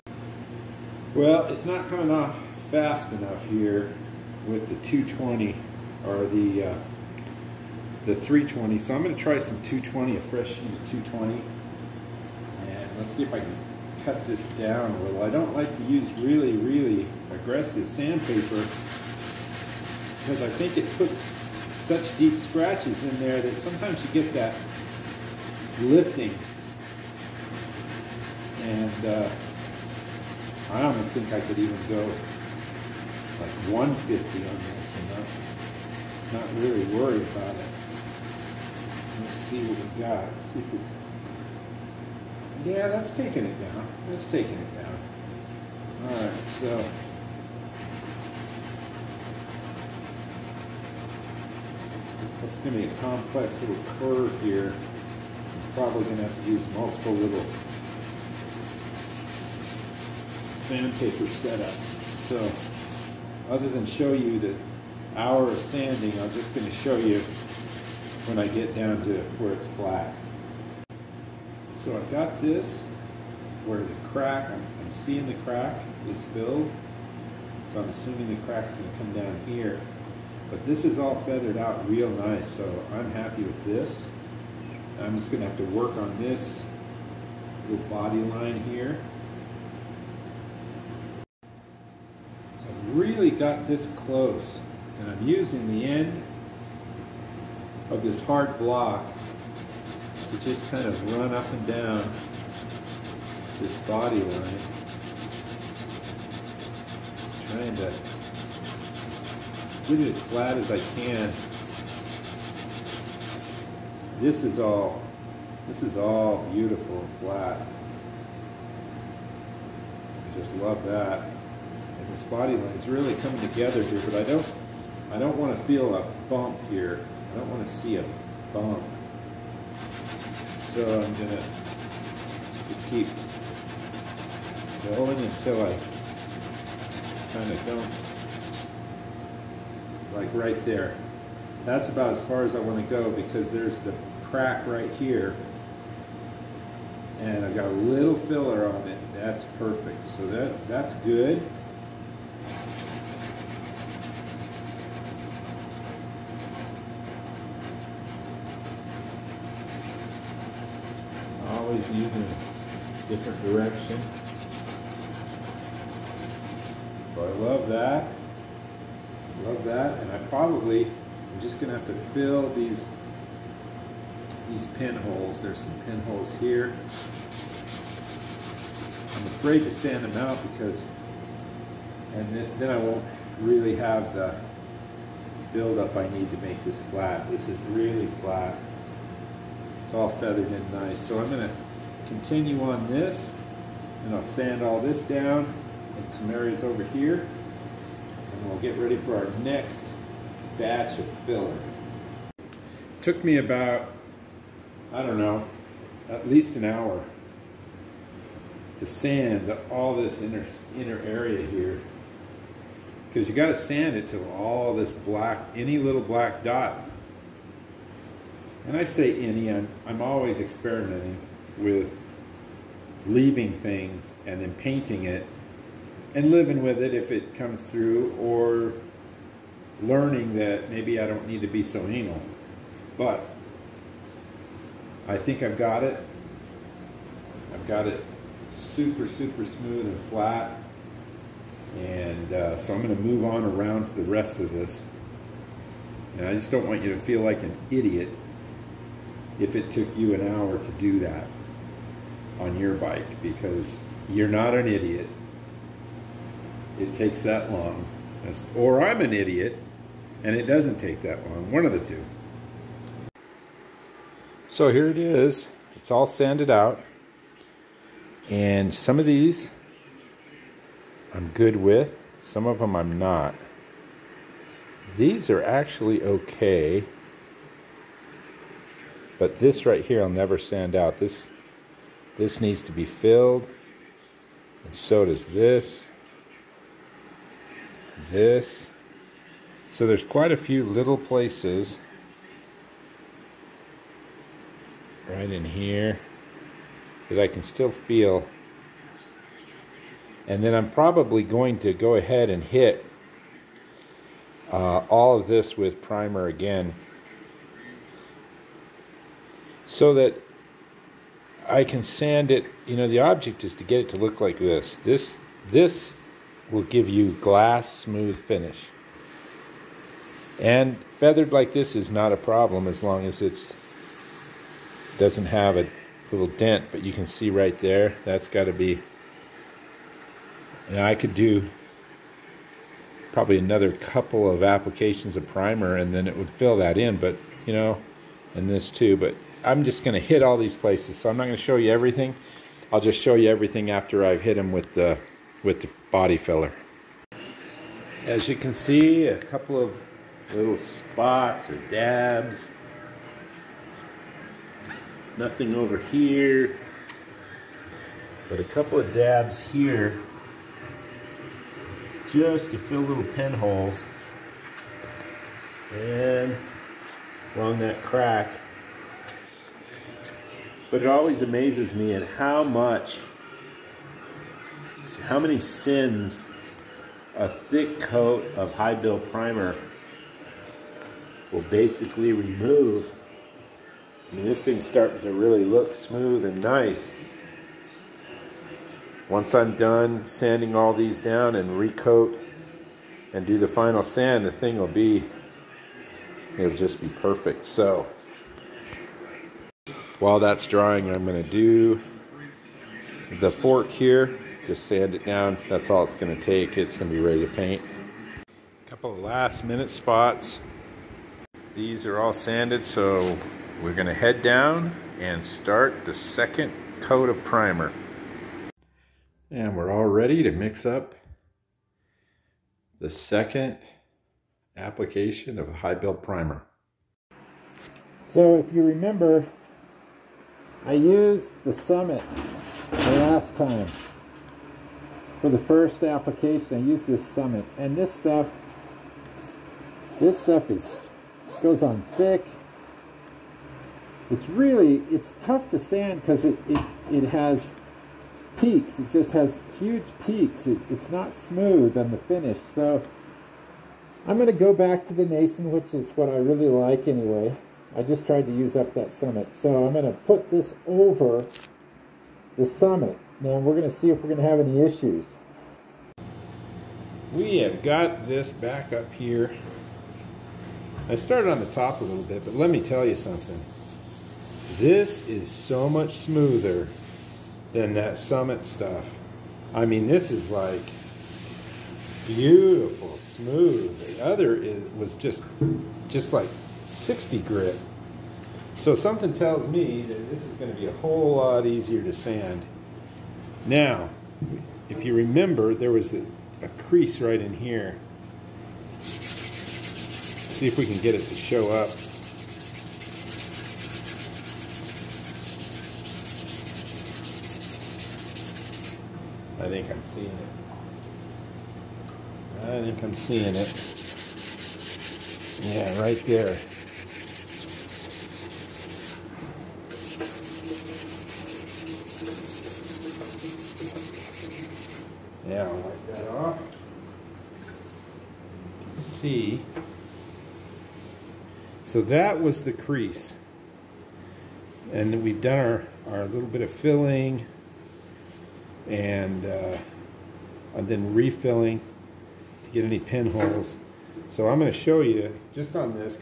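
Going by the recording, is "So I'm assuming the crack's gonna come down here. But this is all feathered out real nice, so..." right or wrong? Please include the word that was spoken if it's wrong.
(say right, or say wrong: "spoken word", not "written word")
right.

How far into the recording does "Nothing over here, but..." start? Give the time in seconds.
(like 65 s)
355 s.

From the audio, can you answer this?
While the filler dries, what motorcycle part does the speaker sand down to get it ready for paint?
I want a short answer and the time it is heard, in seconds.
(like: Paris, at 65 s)
the fork, at 403 s.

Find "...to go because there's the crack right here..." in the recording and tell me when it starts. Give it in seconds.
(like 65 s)
142 s.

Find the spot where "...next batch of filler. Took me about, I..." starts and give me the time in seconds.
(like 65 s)
199 s.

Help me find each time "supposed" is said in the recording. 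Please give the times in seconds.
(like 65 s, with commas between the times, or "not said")
not said.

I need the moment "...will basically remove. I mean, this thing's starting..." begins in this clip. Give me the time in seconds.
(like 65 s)
381 s.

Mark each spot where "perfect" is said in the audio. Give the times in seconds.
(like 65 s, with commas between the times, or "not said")
149 s, 396 s.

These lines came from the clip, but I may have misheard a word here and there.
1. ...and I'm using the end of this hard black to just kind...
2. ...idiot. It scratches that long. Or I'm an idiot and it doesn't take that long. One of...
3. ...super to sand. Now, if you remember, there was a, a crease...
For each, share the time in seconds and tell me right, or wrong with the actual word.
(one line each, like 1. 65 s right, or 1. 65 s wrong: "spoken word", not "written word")
1. 94 s wrong: "block", not "black"
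2. 254 s wrong: "takes", not "scratches"
3. 491 s wrong: "easier", not "super".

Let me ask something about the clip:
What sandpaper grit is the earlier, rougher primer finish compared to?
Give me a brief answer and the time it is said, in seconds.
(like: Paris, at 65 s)
60 grit, at 486 s.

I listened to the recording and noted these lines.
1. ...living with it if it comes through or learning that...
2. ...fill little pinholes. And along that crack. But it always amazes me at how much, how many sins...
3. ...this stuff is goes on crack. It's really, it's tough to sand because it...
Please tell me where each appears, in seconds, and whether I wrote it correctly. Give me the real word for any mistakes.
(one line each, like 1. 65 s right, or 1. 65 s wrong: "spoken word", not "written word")
1. 226 s right
2. 362 s right
3. 439 s wrong: "thick", not "crack".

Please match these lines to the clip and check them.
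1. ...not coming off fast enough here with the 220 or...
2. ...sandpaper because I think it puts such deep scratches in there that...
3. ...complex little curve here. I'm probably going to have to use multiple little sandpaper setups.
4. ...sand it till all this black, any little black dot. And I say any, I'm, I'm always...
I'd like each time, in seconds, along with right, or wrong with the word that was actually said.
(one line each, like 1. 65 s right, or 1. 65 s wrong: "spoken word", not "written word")
1. 1 s right
2. 17 s right
3. 52 s right
4. 213 s right.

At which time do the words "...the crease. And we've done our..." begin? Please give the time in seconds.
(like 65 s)
532 s.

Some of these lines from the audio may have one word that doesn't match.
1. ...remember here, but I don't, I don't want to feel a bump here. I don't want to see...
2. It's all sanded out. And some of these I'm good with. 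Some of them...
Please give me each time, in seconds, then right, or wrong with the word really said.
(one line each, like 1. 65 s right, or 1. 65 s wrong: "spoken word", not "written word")
1. 123 s wrong: "together", not "remember"
2. 265 s right.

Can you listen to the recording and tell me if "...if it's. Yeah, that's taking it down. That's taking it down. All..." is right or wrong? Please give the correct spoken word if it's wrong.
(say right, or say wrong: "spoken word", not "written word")
right.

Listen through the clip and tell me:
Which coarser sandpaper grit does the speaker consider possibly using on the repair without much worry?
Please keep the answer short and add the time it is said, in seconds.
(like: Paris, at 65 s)
150, at 33 s.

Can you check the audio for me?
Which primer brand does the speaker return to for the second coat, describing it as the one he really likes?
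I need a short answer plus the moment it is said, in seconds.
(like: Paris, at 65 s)
Nason, at 455 s.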